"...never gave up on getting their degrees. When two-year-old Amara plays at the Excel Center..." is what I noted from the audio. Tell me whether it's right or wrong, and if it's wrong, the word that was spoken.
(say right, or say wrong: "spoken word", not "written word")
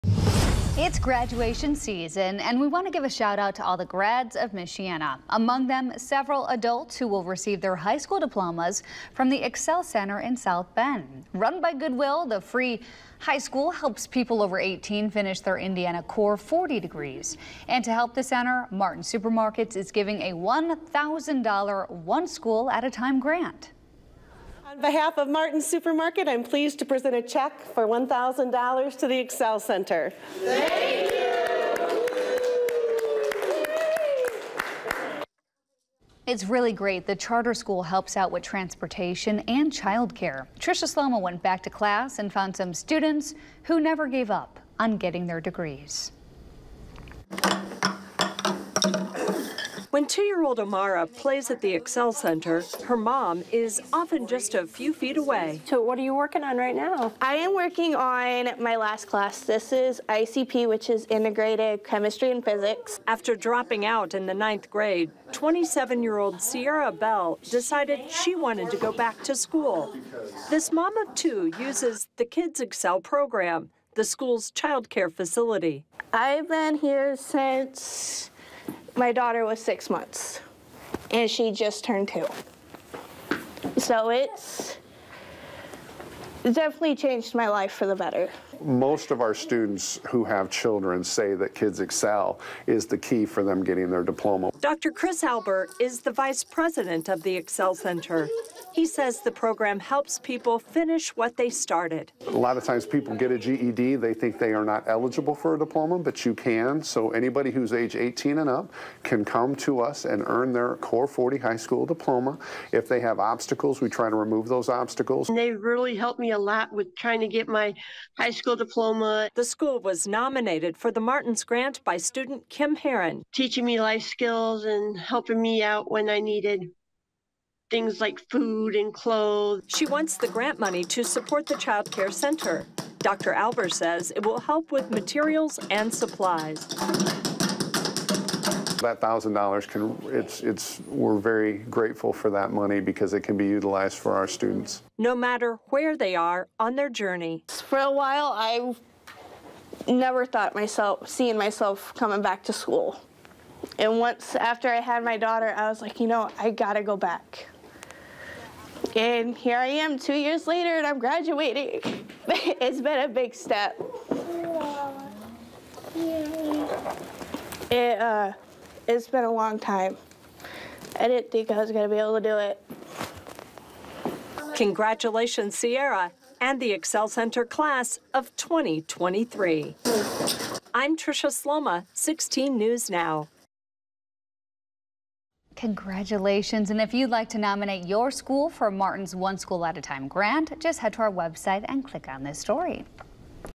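right.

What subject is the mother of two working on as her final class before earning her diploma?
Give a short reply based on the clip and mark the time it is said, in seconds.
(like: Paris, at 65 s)
Integrated Chemistry and Physics, at 61 s.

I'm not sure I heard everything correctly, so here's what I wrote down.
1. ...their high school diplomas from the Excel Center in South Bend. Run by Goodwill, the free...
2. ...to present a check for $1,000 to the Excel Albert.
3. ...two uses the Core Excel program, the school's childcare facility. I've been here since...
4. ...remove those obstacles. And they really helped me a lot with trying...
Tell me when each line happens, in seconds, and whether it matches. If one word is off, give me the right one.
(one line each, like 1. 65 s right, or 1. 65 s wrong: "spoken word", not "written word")
1. 7 s right
2. 26 s wrong: "Center", not "Albert"
3. 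71 s wrong: "Kids", not "Core"
4. 114 s right.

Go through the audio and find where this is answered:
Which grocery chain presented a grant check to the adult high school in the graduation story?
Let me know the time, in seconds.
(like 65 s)
18 s.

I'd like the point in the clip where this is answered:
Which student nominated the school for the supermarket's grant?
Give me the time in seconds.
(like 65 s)
122 s.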